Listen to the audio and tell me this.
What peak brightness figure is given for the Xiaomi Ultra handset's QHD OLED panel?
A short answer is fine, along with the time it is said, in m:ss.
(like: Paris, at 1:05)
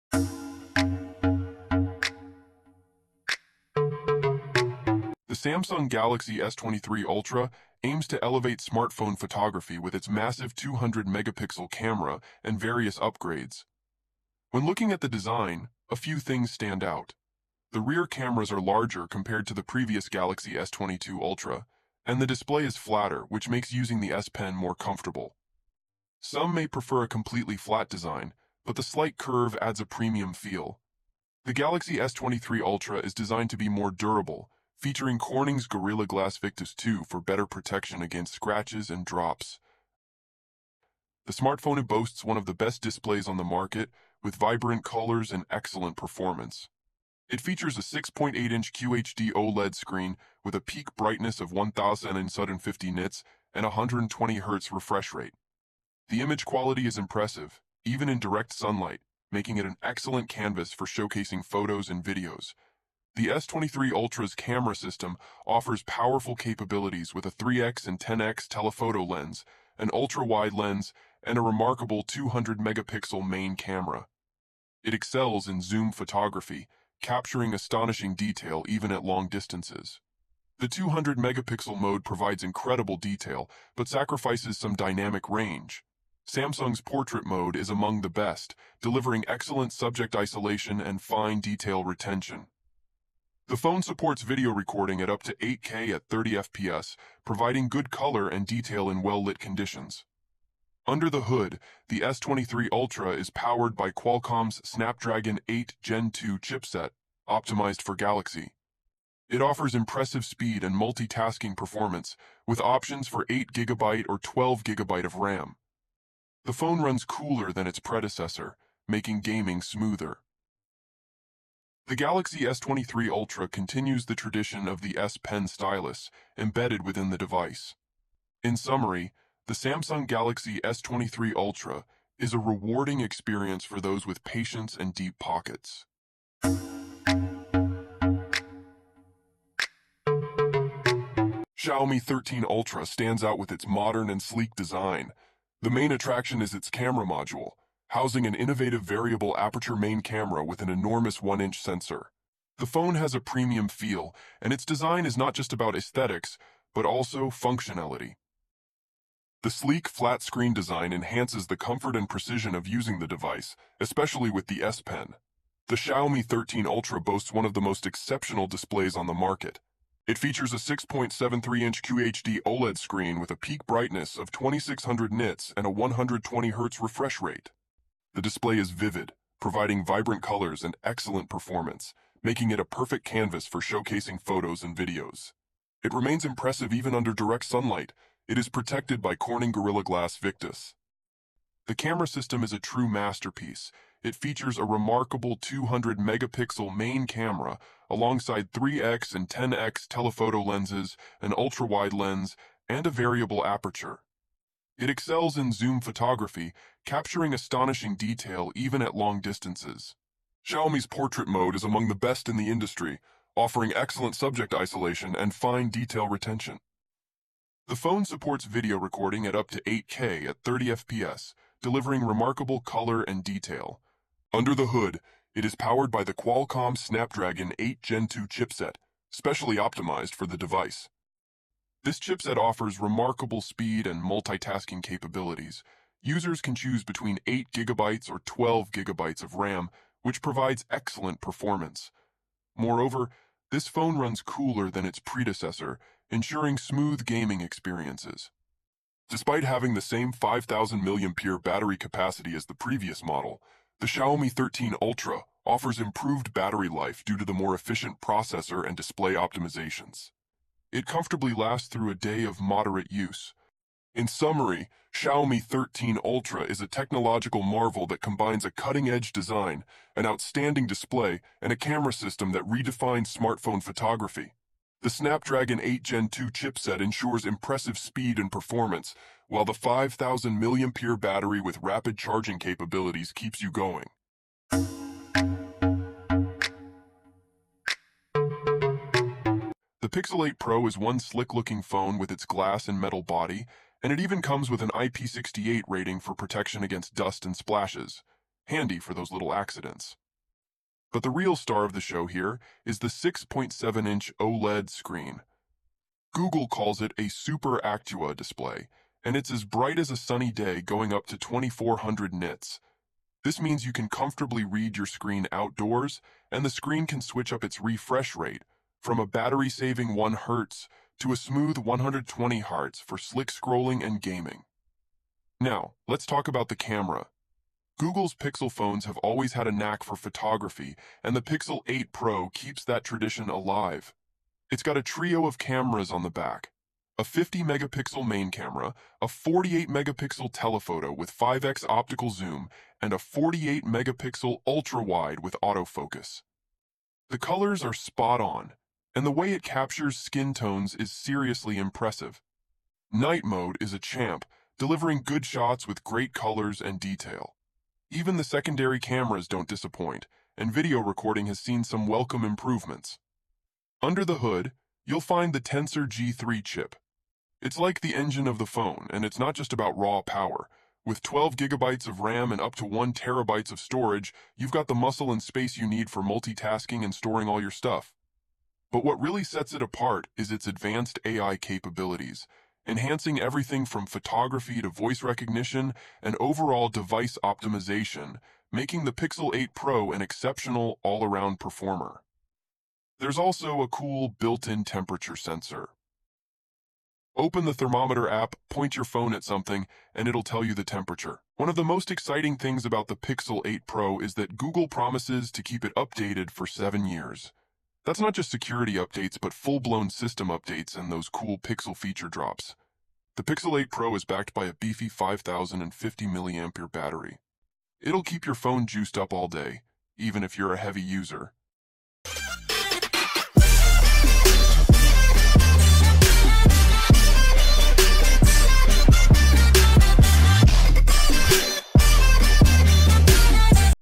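2600 nits, at 2:54.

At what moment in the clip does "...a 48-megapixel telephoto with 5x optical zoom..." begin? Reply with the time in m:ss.
5:39.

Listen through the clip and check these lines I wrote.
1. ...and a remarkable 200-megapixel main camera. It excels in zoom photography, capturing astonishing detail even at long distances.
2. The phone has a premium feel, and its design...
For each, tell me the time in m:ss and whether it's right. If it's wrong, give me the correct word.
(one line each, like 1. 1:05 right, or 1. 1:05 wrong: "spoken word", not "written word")
1. 1:11 right
2. 2:32 right.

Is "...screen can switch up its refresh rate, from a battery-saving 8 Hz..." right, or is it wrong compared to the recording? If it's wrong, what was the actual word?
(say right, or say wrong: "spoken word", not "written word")
wrong: "1", not "8".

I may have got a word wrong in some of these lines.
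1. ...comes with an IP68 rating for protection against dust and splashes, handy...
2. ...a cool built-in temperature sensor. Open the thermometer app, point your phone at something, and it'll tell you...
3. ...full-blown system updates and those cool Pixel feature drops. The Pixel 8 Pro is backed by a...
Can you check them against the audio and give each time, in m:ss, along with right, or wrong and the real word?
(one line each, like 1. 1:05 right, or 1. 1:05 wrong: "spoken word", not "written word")
1. 4:54 right
2. 6:33 right
3. 6:49 right.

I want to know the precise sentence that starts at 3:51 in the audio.
This chipset offers remarkable speed and multitasking capabilities.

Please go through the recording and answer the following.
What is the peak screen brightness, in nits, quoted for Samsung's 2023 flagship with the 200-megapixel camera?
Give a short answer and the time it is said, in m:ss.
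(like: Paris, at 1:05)
1050 nits, at 0:51.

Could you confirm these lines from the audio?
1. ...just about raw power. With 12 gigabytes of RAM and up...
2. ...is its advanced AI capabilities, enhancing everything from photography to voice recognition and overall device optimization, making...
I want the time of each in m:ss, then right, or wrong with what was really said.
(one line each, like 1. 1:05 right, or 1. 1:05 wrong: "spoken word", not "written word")
1. 6:09 right
2. 6:20 right.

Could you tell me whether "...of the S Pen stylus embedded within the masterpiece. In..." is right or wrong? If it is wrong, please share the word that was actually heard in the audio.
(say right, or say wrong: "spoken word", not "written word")
wrong: "device", not "masterpiece".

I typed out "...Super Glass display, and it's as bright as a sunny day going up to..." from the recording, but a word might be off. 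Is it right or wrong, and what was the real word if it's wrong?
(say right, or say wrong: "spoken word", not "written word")
wrong: "Actua", not "Glass".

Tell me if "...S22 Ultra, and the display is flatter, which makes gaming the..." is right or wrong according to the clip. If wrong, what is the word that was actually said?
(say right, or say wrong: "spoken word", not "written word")
wrong: "using", not "gaming".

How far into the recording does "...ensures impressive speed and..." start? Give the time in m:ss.
4:36.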